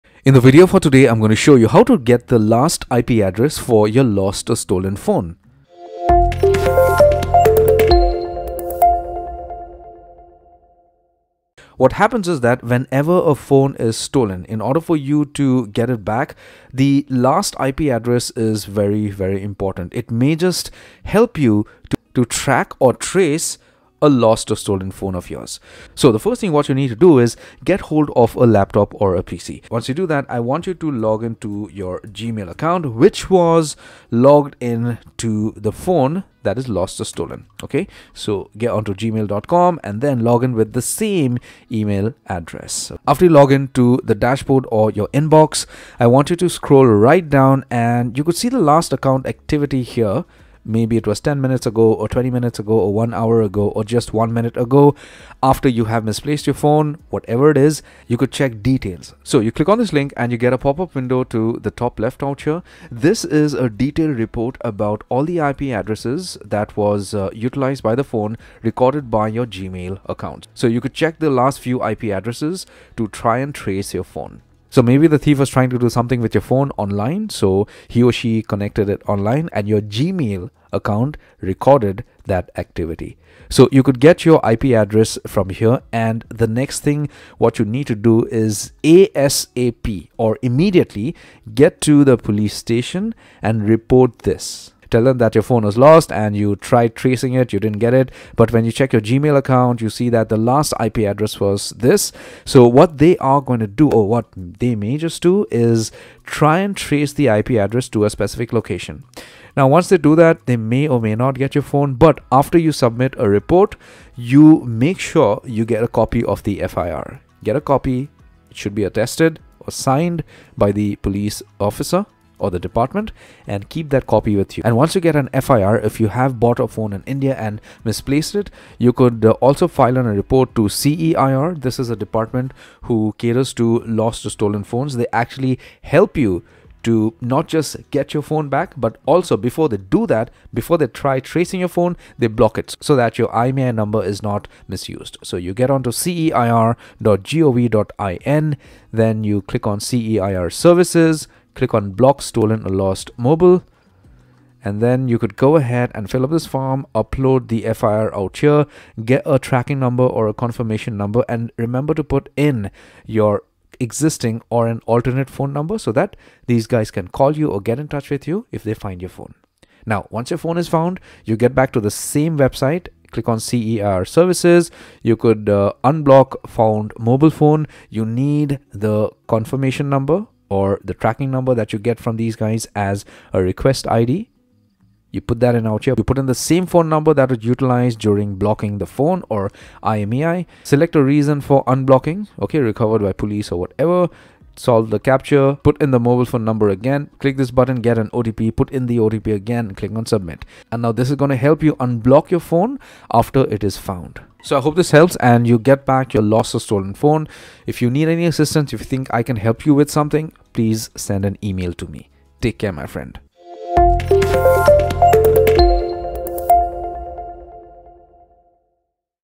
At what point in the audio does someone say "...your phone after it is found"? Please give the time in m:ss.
3:22.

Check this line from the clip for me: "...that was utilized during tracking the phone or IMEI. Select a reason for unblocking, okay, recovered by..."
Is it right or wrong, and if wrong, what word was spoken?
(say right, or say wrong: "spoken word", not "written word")
wrong: "blocking", not "tracking".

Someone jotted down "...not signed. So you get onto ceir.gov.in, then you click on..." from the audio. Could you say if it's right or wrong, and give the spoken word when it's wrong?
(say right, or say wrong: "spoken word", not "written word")
wrong: "misused", not "signed".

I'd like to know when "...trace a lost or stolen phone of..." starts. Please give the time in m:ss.
0:22.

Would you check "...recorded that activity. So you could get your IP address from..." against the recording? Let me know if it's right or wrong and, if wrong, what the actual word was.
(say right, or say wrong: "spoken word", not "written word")
right.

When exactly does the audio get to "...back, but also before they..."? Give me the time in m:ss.
2:18.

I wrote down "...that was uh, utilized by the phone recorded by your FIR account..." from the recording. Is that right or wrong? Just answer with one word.
wrong.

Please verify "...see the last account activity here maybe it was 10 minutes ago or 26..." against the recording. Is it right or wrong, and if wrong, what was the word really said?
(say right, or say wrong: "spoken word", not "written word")
wrong: "20", not "26".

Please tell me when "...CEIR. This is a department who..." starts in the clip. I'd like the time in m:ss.
2:10.